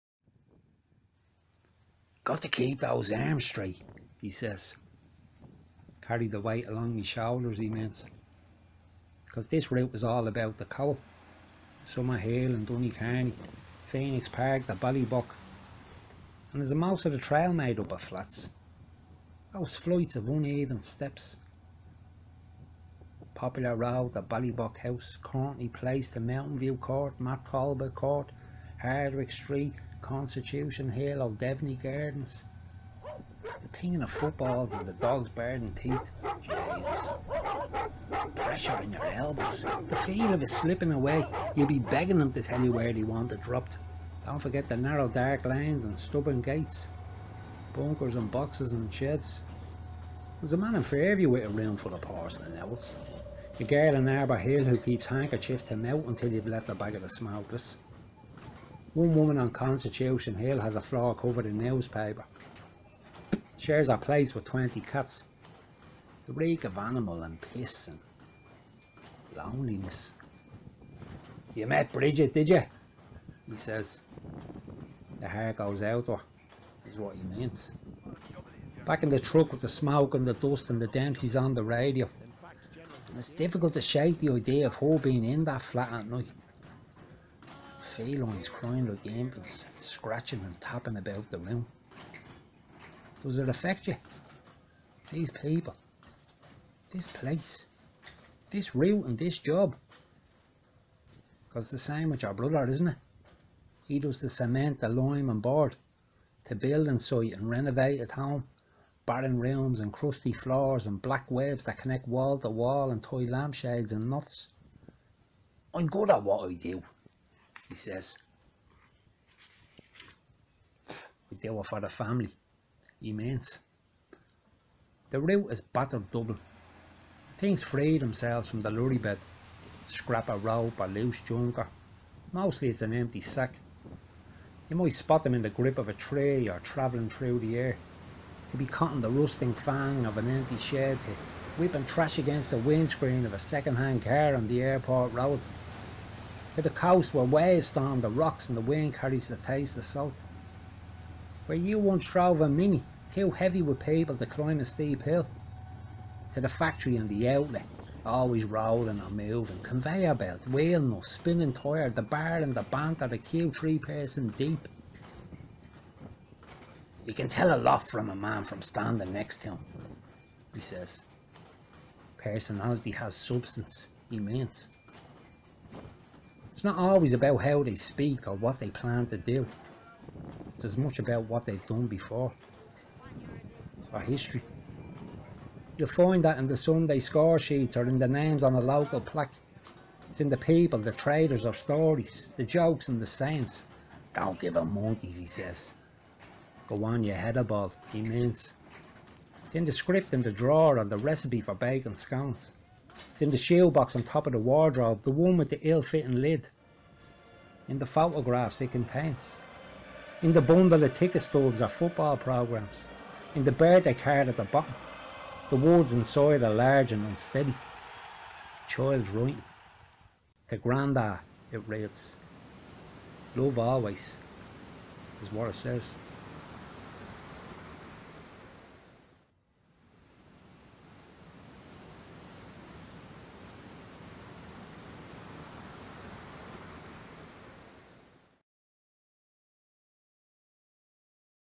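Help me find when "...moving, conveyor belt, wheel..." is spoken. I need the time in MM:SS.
02:39.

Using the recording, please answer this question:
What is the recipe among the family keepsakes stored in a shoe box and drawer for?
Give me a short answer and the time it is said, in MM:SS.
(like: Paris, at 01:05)
bacon scones, at 03:21.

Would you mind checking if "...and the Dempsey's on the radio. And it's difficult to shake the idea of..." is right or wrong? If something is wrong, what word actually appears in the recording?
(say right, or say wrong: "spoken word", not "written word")
right.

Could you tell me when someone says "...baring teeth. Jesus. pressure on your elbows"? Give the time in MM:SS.
00:35.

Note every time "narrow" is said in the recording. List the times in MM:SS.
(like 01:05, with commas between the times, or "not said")
00:44.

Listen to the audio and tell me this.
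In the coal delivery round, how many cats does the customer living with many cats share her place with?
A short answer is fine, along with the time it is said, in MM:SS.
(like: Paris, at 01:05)
20, at 01:04.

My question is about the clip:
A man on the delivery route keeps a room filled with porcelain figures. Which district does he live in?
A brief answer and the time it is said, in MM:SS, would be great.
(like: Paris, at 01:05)
Fairview, at 00:50.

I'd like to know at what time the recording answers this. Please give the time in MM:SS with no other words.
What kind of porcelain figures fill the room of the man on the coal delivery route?
00:52.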